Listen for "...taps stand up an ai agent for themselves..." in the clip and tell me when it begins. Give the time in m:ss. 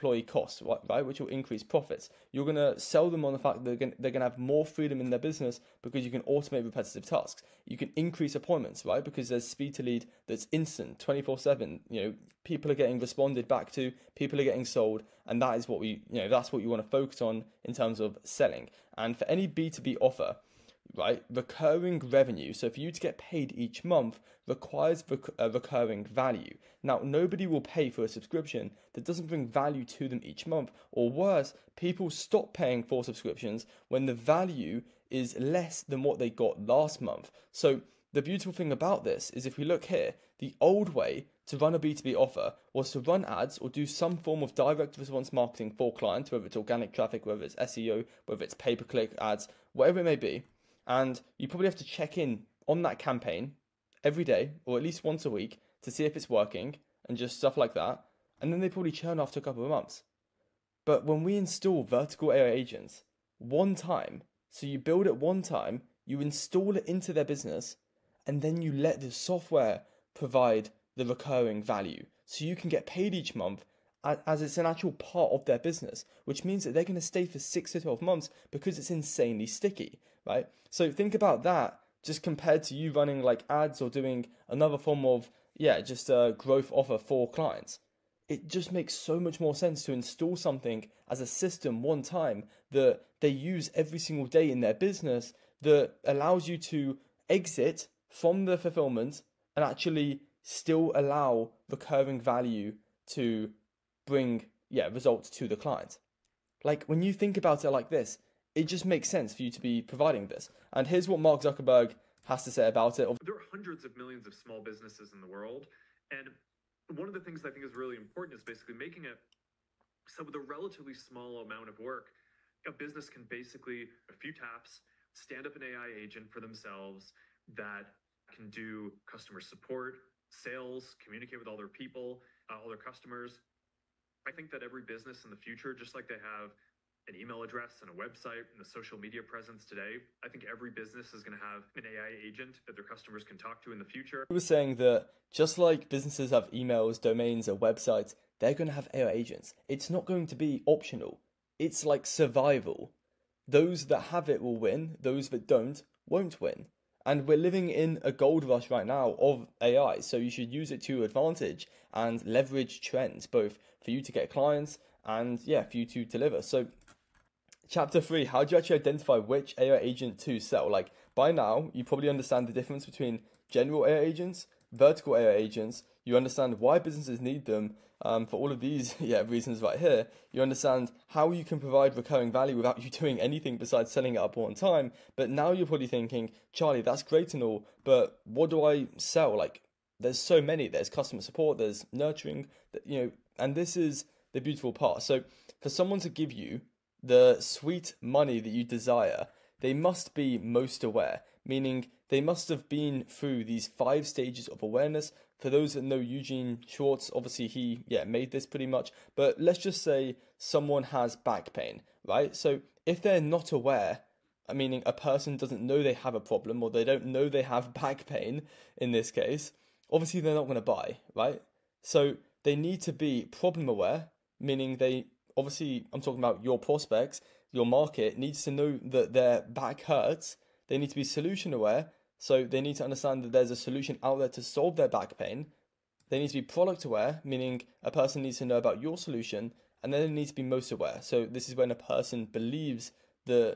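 2:04.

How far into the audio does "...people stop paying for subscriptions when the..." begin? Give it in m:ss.
0:31.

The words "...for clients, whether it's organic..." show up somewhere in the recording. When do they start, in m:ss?
0:45.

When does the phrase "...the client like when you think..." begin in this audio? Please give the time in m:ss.
1:45.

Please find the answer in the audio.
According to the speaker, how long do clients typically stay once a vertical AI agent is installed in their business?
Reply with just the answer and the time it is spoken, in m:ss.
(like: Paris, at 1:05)
6 to 12 months, at 1:17.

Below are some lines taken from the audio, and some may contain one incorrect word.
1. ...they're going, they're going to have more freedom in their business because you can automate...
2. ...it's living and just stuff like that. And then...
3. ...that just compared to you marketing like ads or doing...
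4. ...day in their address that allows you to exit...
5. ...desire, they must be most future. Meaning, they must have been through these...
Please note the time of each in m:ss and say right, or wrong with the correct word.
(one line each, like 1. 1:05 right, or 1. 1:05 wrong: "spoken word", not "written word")
1. 0:03 right
2. 0:56 wrong: "working", not "living"
3. 1:21 wrong: "running", not "marketing"
4. 1:34 wrong: "business", not "address"
5. 3:18 wrong: "aware", not "future".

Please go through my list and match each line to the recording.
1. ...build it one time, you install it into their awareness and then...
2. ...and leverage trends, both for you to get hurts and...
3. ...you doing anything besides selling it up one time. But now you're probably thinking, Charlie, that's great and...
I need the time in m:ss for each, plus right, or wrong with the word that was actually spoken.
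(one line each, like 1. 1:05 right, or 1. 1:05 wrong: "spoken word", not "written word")
1. 1:04 wrong: "business", not "awareness"
2. 2:41 wrong: "clients", not "hurts"
3. 3:02 right.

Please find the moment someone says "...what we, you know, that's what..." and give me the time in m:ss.
0:15.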